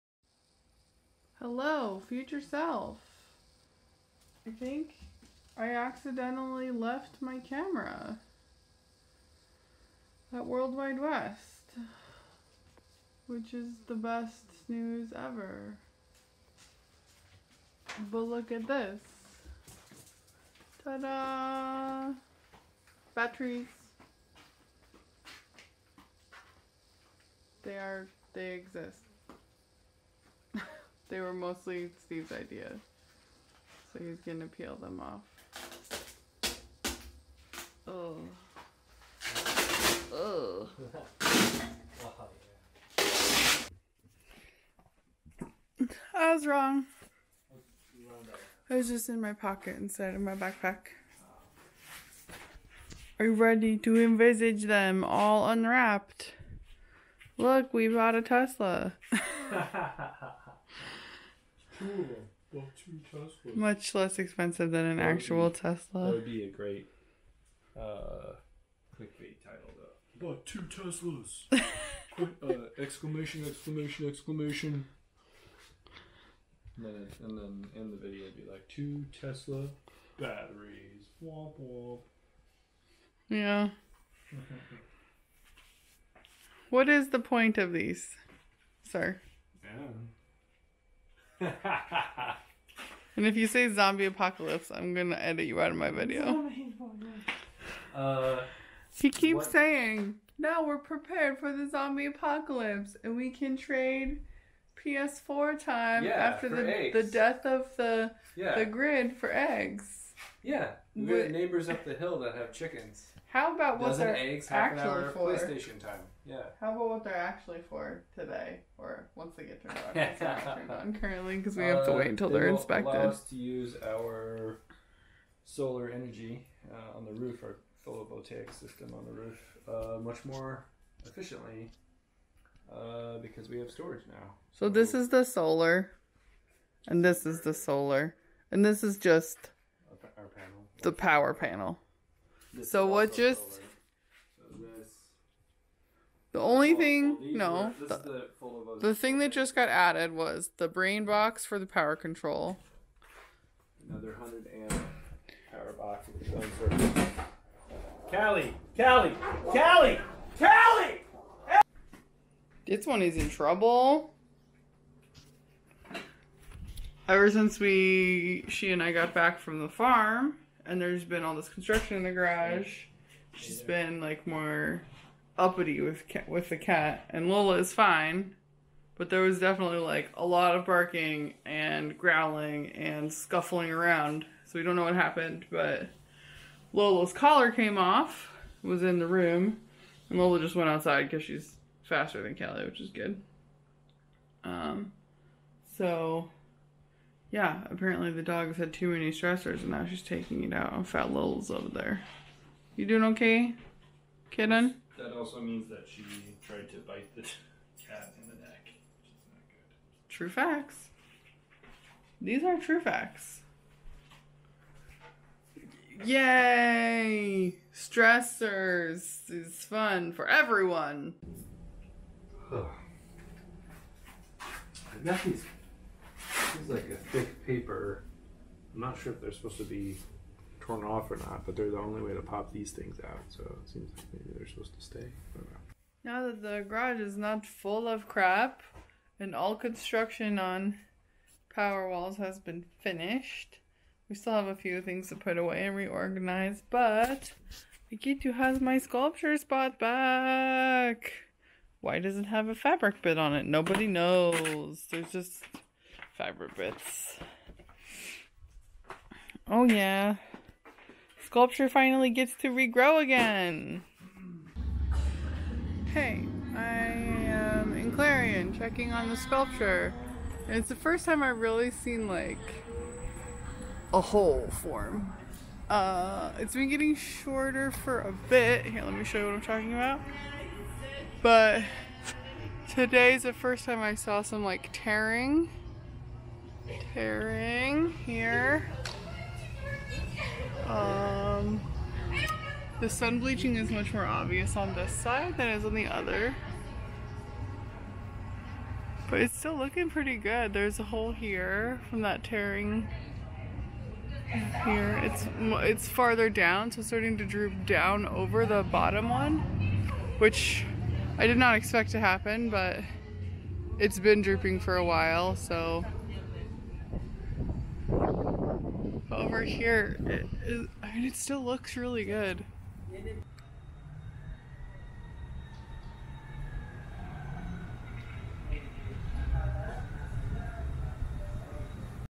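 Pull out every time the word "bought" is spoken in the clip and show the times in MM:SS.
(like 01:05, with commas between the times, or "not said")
00:57, 01:10.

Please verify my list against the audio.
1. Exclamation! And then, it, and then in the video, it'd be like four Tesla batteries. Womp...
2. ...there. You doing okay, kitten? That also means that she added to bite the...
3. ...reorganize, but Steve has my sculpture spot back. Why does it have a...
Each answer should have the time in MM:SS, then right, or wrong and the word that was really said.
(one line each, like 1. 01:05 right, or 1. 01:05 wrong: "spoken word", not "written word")
1. 01:14 wrong: "two", not "four"
2. 03:21 wrong: "tried", not "added"
3. 04:05 wrong: "Ikitu", not "Steve".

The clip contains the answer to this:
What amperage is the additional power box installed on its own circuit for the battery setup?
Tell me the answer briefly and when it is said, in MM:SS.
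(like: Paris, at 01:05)
100 amp, at 02:34.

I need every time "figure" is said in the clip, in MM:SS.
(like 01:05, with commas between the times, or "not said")
not said.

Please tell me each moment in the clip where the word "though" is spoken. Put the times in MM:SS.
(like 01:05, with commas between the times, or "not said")
01:09.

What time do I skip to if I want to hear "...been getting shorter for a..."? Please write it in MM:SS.
04:36.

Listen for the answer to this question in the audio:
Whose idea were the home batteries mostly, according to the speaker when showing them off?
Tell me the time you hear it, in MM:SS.
00:32.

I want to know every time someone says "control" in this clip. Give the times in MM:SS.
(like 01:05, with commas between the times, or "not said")
02:31.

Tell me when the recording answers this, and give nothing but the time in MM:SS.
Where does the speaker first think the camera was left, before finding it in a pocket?
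00:10.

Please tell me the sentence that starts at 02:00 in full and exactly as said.
turned on currently because we have to uh, wait until Uh, they are inspected.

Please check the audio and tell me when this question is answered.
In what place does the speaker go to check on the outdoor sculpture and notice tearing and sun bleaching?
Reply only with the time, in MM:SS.
04:27.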